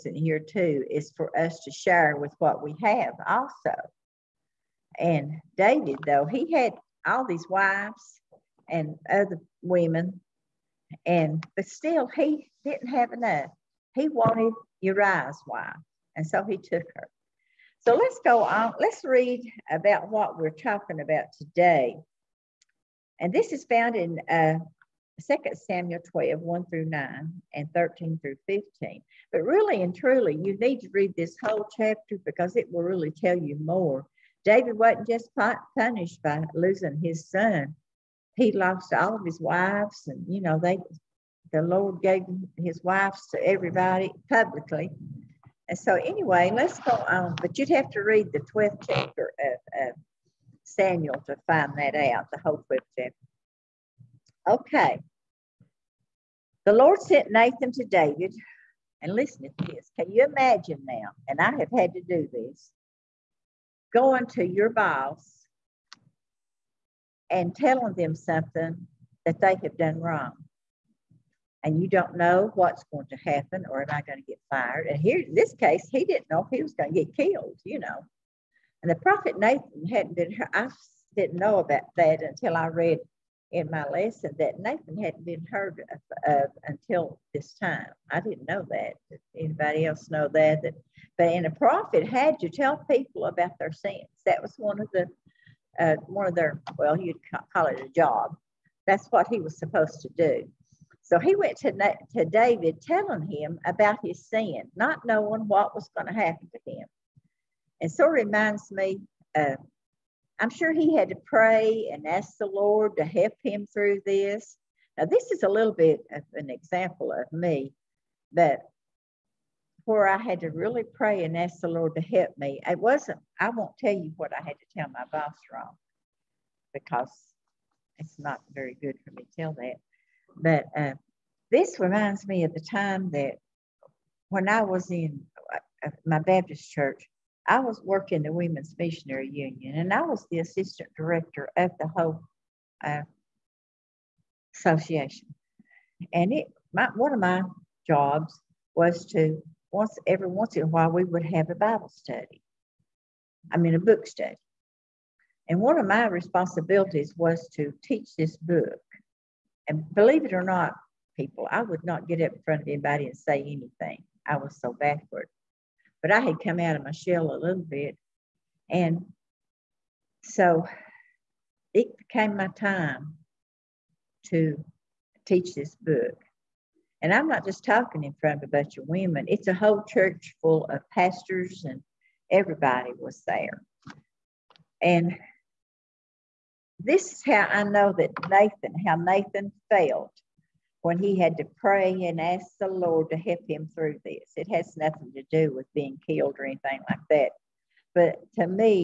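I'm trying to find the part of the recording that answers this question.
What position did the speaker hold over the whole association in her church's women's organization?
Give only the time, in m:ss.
2:20.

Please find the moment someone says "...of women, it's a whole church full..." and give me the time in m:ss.
2:58.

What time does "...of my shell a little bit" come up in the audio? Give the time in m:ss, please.
2:46.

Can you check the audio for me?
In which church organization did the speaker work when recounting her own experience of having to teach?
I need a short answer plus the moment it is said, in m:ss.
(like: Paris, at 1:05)
Women's Missionary Union, at 2:18.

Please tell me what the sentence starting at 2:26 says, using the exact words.
And it, my, one of my jobs was to once every once in a while we would have a Bible study.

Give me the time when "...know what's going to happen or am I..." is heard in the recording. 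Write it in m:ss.
1:12.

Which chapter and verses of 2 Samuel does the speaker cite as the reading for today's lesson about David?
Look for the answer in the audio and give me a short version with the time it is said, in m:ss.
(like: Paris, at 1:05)
2 Samuel 12:1-9 and 13-15, at 0:25.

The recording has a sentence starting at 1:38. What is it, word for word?
That's what he was supposed to do.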